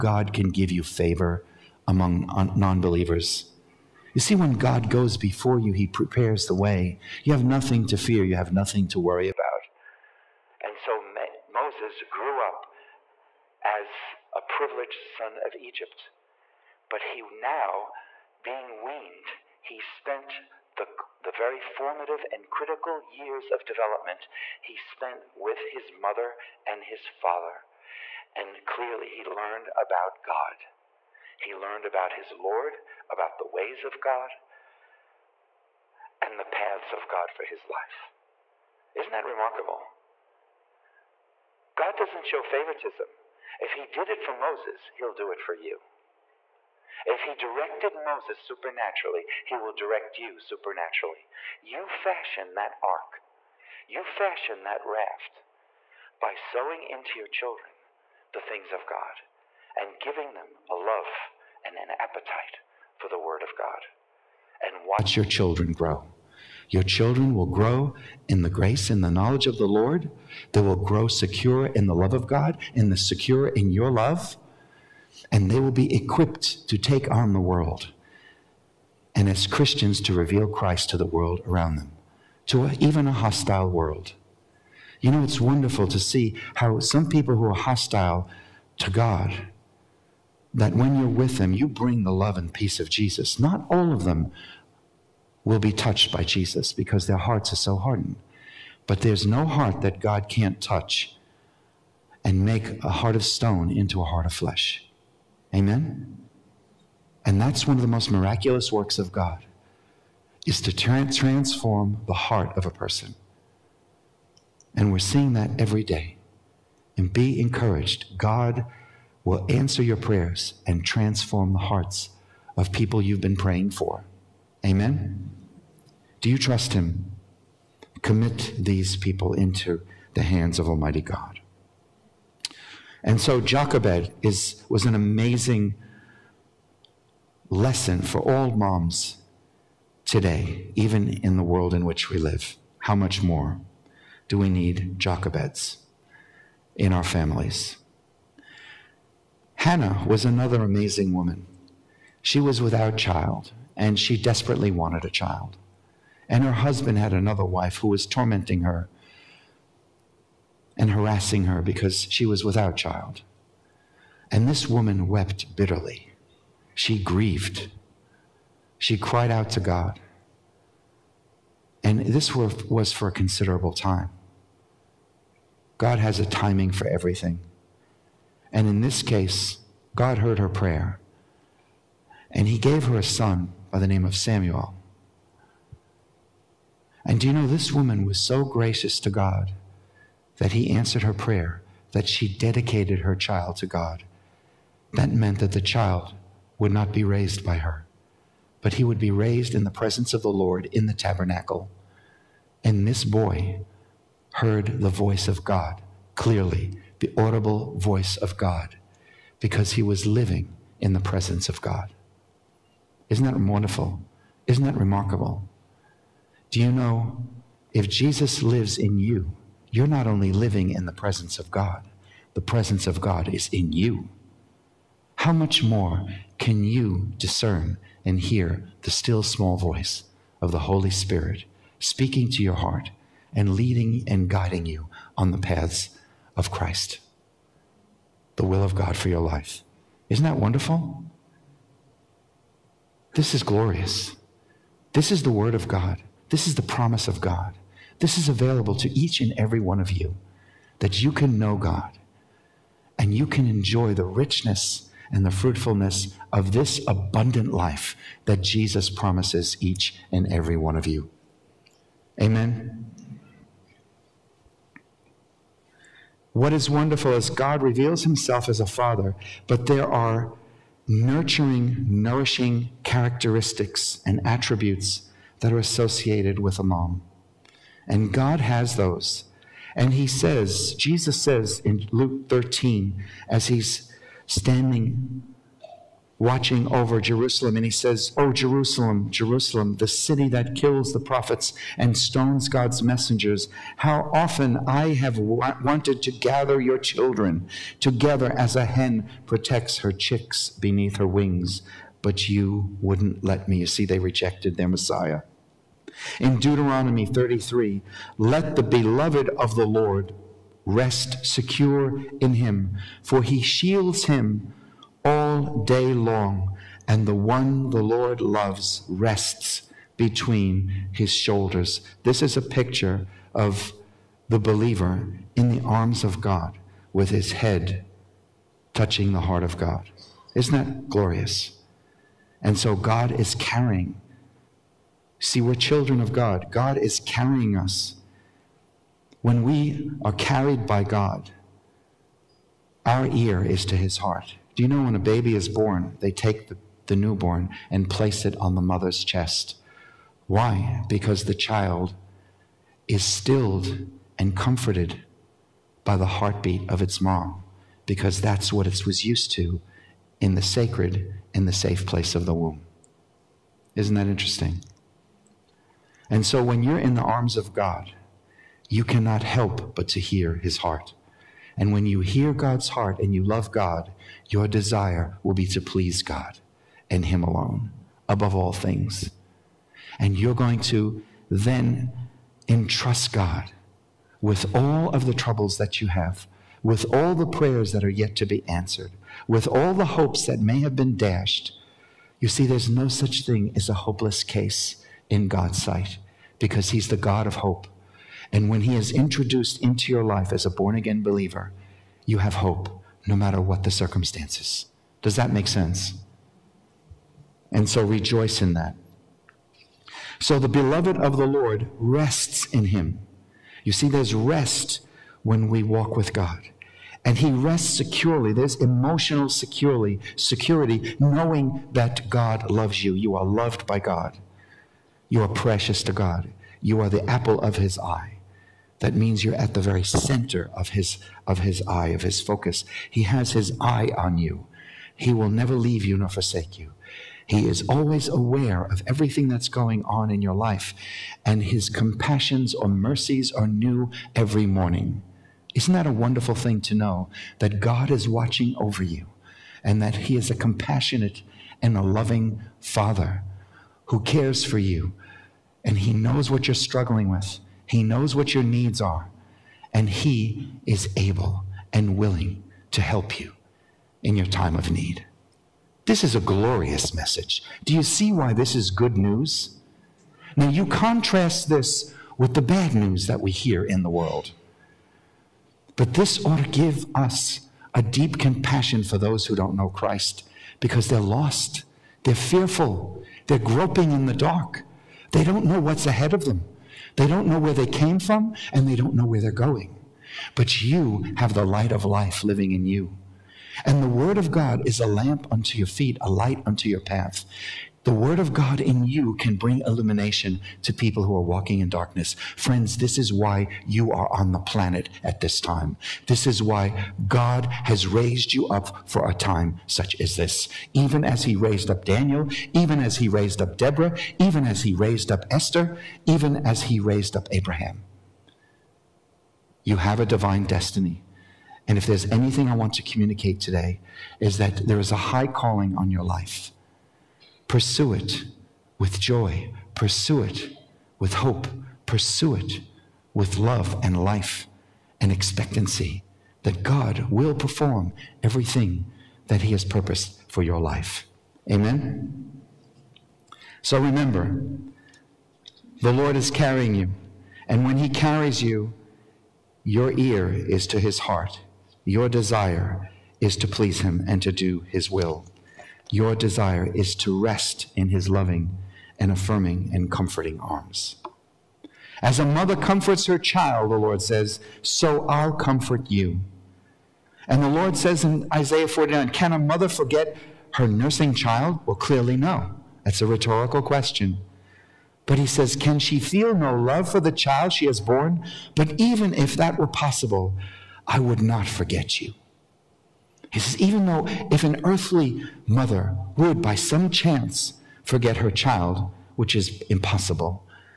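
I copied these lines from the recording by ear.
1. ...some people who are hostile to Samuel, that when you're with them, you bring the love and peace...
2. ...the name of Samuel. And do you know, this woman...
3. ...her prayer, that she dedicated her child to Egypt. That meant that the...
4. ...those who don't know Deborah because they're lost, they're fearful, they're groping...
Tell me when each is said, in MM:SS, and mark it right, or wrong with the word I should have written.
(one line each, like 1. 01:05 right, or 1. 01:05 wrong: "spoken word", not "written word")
1. 01:26 wrong: "God", not "Samuel"
2. 03:03 right
3. 03:11 wrong: "God", not "Egypt"
4. 07:58 wrong: "Christ", not "Deborah".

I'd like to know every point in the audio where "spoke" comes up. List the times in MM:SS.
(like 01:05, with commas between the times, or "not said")
not said.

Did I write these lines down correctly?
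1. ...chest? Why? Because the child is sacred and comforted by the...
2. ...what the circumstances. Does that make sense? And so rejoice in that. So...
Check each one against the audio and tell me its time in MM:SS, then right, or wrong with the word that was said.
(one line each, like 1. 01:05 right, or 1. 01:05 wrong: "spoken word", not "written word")
1. 05:49 wrong: "stilled", not "sacred"
2. 06:43 right.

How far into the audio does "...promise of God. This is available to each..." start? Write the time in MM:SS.
04:06.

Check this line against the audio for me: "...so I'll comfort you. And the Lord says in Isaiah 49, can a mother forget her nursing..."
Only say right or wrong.
right.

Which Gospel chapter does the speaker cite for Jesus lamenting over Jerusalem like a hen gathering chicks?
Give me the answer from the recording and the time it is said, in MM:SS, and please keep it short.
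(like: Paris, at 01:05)
Luke 13, at 04:41.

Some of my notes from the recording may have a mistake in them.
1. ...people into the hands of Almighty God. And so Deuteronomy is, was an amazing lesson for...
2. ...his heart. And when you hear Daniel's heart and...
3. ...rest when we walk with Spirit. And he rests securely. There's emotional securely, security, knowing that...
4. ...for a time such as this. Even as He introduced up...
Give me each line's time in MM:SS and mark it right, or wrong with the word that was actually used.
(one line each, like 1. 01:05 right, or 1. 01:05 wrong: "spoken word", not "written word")
1. 02:08 wrong: "Jochebed", not "Deuteronomy"
2. 06:10 wrong: "God", not "Daniel"
3. 06:54 wrong: "God", not "Spirit"
4. 08:28 wrong: "raised", not "introduced".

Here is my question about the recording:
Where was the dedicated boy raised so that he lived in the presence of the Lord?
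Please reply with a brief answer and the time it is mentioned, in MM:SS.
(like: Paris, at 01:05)
the tabernacle, at 03:20.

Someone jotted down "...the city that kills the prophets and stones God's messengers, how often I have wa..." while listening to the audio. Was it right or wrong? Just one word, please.
right.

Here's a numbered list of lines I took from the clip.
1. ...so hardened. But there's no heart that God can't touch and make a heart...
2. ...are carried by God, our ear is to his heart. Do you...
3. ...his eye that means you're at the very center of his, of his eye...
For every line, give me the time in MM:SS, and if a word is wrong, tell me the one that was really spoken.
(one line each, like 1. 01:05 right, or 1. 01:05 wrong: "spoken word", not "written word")
1. 01:37 right
2. 05:40 right
3. 07:07 right.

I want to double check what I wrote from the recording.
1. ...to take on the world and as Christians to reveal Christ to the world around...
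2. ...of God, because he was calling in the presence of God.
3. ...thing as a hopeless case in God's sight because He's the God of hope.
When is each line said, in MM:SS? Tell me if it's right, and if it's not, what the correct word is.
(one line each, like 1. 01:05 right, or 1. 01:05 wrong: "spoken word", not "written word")
1. 01:16 right
2. 03:28 wrong: "living", not "calling"
3. 06:33 right.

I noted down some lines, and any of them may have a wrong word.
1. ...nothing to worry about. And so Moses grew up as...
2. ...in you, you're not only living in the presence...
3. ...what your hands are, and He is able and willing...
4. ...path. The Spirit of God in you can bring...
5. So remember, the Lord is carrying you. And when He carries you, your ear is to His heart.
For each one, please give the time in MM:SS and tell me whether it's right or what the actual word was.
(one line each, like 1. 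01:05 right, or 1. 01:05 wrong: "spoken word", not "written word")
1. 00:08 right
2. 03:38 right
3. 07:38 wrong: "needs", not "hands"
4. 08:16 wrong: "Word", not "Spirit"
5. 09:03 right.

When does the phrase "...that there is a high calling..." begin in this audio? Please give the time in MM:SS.
08:44.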